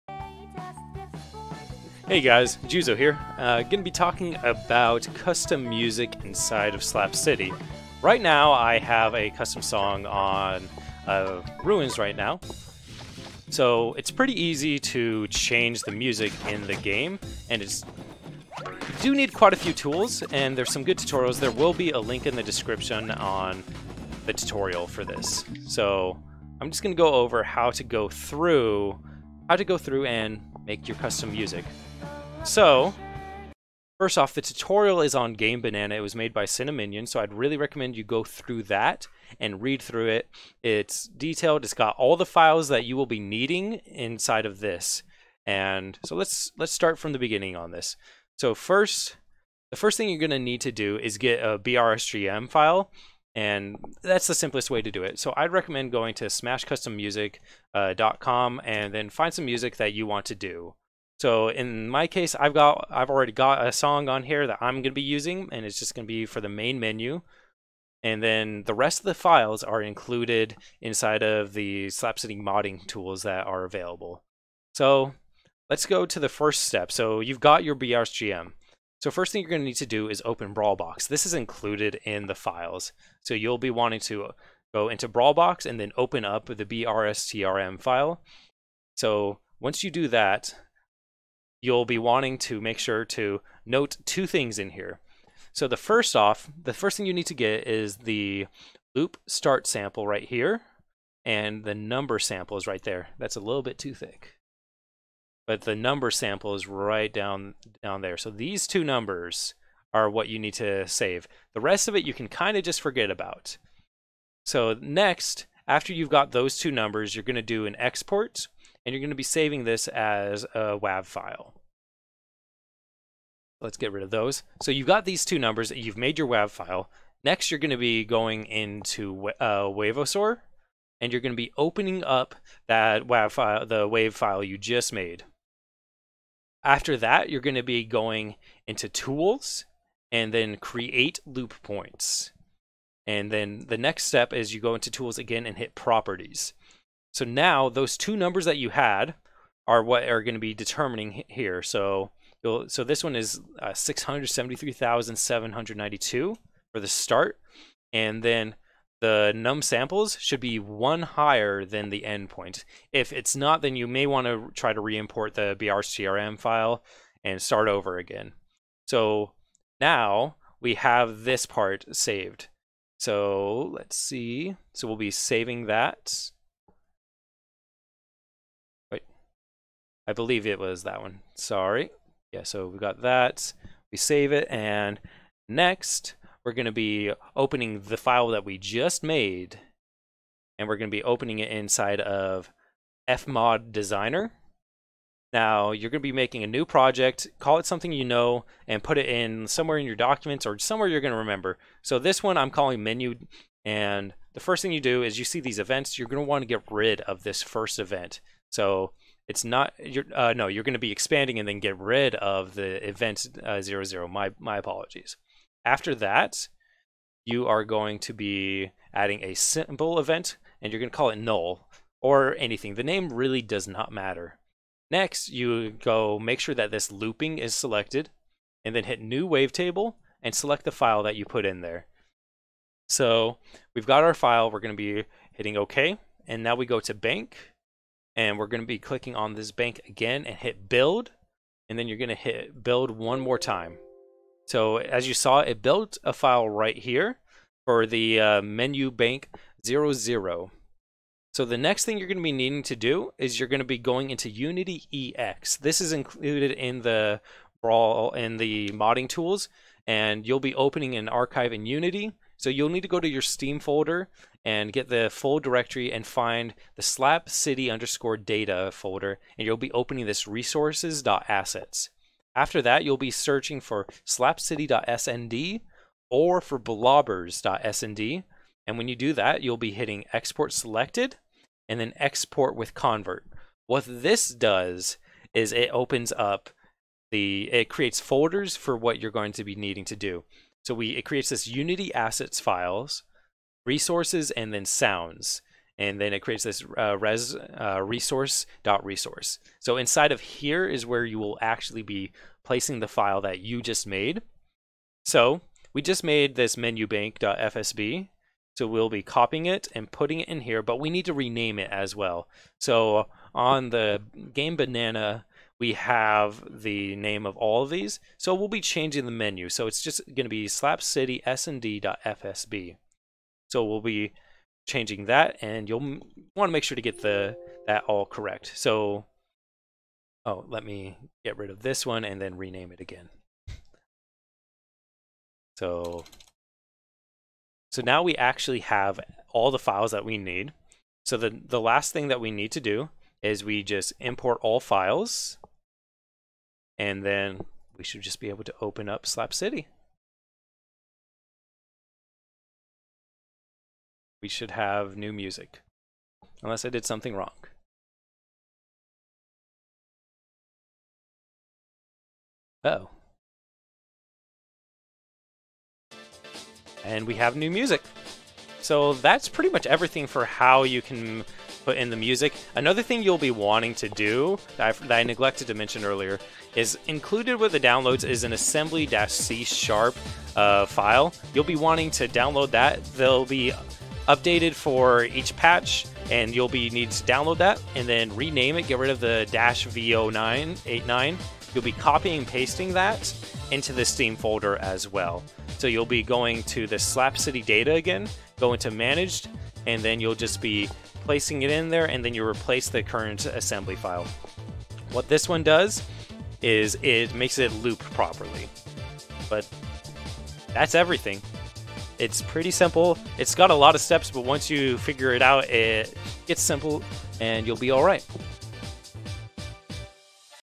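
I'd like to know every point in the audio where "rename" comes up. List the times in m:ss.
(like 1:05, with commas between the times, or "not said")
5:11, 5:32, 6:28.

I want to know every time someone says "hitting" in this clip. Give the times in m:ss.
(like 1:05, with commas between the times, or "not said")
3:55, 4:39.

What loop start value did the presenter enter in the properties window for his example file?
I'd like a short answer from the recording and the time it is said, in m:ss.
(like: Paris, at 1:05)
673,792, at 2:33.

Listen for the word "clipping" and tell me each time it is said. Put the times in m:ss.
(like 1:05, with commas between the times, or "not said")
not said.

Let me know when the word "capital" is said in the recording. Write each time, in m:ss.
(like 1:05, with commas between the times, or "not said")
not said.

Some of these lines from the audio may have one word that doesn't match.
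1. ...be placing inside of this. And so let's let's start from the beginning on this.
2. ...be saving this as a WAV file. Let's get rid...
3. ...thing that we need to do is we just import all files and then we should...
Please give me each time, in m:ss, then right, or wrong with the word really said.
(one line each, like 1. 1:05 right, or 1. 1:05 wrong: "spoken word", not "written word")
1. 0:43 wrong: "needing", not "placing"
2. 1:59 right
3. 5:41 right.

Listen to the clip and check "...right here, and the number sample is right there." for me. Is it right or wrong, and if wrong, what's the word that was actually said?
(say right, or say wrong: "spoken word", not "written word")
right.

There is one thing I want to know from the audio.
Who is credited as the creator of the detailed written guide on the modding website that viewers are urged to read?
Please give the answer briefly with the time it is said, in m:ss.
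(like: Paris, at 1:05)
Cinnaminion, at 0:36.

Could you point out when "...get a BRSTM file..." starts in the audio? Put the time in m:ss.
0:51.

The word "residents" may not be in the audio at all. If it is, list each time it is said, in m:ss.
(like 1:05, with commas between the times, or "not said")
not said.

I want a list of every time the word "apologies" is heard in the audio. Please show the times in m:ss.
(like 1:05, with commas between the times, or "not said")
3:34.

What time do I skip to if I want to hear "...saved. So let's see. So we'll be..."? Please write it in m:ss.
2:51.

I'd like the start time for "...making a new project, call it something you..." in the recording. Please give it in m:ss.
3:16.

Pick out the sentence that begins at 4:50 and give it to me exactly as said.
So we it creates this Unity assets files, resources, and then sounds.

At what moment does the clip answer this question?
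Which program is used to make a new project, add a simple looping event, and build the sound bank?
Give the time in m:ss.
3:13.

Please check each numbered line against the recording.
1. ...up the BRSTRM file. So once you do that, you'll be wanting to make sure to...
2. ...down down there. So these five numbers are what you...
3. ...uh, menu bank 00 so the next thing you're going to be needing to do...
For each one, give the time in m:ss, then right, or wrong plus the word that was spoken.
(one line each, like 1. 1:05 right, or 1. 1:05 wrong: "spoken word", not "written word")
1. 1:26 right
2. 1:47 wrong: "two", not "five"
3. 4:08 right.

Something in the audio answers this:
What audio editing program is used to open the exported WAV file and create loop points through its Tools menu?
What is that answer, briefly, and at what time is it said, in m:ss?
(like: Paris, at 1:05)
Wavosaur, at 2:09.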